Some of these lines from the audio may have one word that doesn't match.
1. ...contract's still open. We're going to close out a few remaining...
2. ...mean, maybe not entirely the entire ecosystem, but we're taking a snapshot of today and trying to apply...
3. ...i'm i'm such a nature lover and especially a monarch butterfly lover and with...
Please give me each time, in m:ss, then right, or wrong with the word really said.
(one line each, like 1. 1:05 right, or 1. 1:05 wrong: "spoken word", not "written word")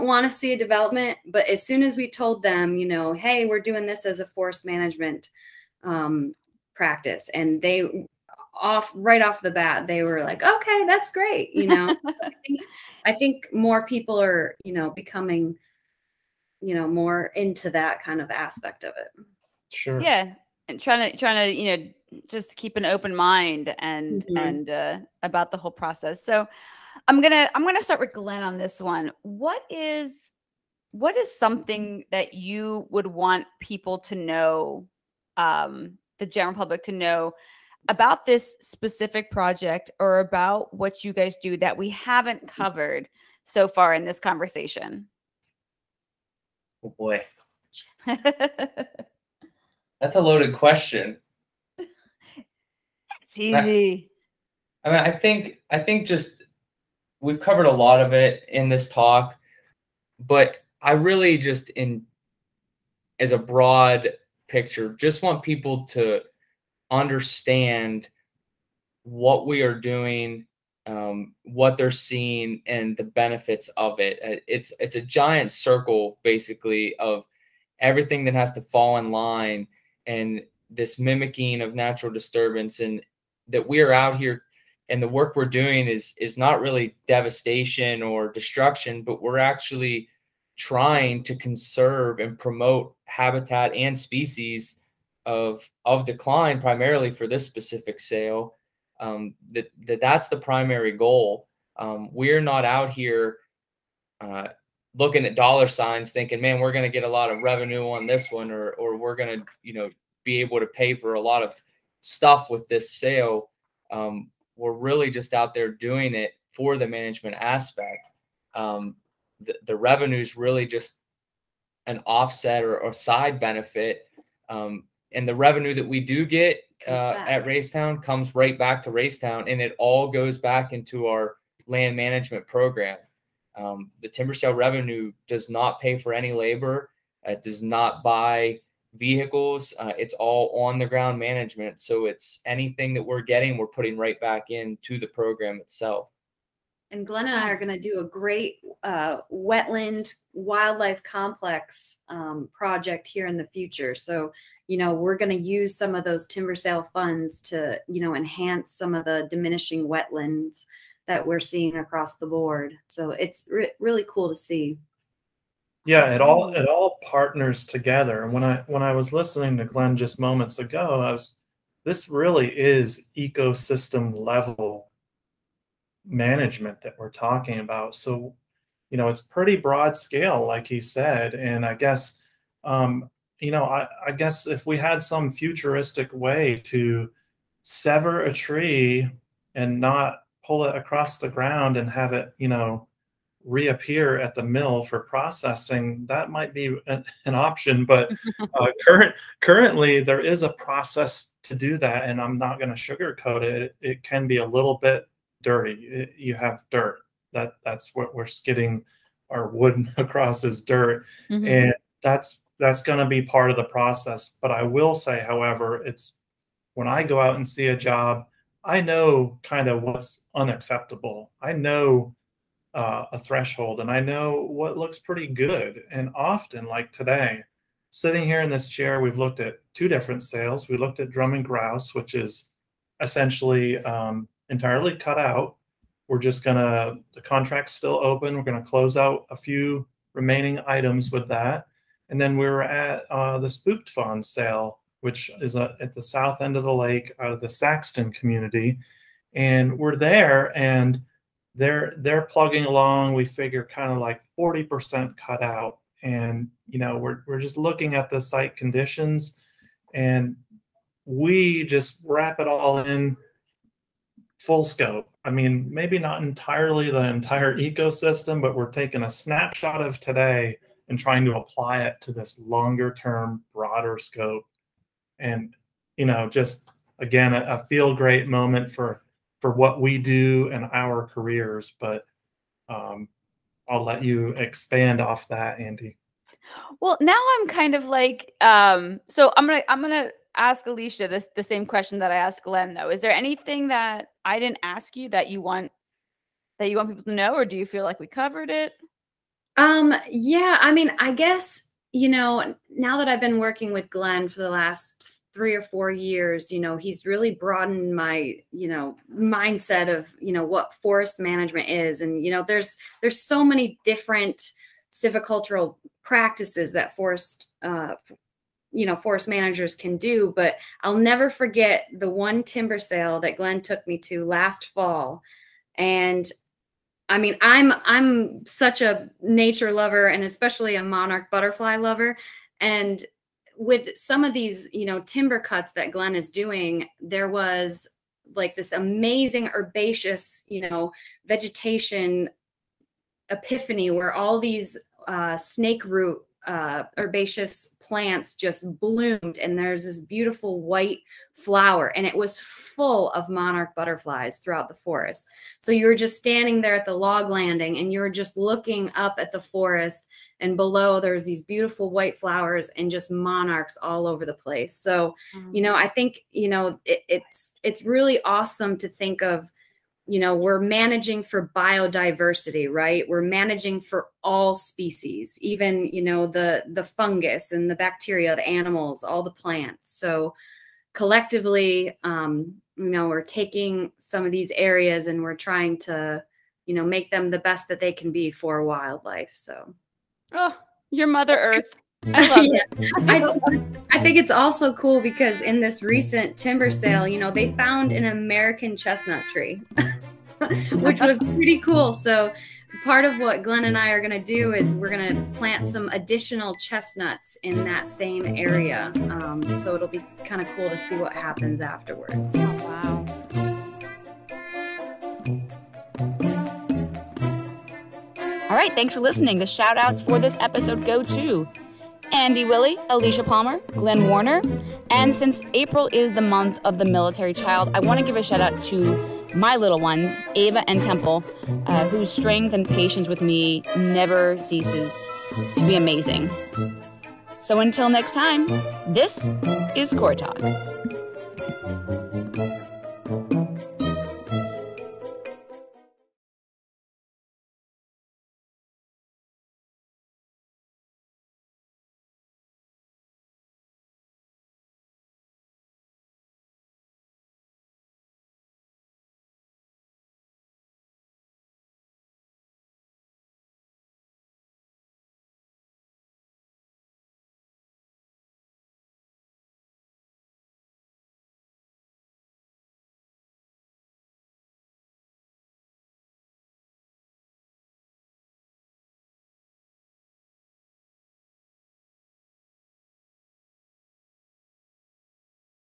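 1. 3:57 right
2. 4:25 right
3. 5:27 right.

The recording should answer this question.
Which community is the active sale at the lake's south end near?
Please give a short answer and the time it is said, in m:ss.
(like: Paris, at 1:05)
Saxton, at 4:07.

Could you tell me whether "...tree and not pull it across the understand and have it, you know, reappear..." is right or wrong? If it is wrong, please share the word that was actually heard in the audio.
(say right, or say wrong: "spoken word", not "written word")
wrong: "ground", not "understand".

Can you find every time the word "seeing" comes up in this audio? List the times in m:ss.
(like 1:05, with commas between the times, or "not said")
1:11, 2:41.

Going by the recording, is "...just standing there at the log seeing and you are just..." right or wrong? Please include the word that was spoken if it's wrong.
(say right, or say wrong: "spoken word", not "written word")
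wrong: "landing", not "seeing".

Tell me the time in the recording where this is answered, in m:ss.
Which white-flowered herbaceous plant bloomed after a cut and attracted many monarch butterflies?
5:45.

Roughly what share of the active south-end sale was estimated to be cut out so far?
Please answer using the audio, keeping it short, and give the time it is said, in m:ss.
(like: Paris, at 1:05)
40%, at 4:14.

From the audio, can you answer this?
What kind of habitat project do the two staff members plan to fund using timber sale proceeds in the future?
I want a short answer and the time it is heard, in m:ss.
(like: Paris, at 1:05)
wetland wildlife complex, at 2:29.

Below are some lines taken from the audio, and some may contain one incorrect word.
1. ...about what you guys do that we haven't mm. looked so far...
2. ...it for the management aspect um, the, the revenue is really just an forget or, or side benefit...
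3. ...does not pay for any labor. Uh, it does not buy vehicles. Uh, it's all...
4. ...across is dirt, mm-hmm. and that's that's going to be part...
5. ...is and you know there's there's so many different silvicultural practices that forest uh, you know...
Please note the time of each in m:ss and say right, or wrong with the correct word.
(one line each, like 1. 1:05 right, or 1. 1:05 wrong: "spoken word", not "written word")
1. 0:40 wrong: "covered", not "looked"
2. 1:56 wrong: "offset", not "forget"
3. 2:15 right
4. 3:29 right
5. 5:11 right.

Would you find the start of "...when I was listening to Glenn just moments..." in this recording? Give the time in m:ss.
2:48.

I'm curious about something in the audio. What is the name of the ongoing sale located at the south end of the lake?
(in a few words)
Spooked Fawn.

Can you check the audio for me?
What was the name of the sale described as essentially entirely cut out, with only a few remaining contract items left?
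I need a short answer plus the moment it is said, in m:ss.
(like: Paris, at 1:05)
Drumming Grouse, at 3:51.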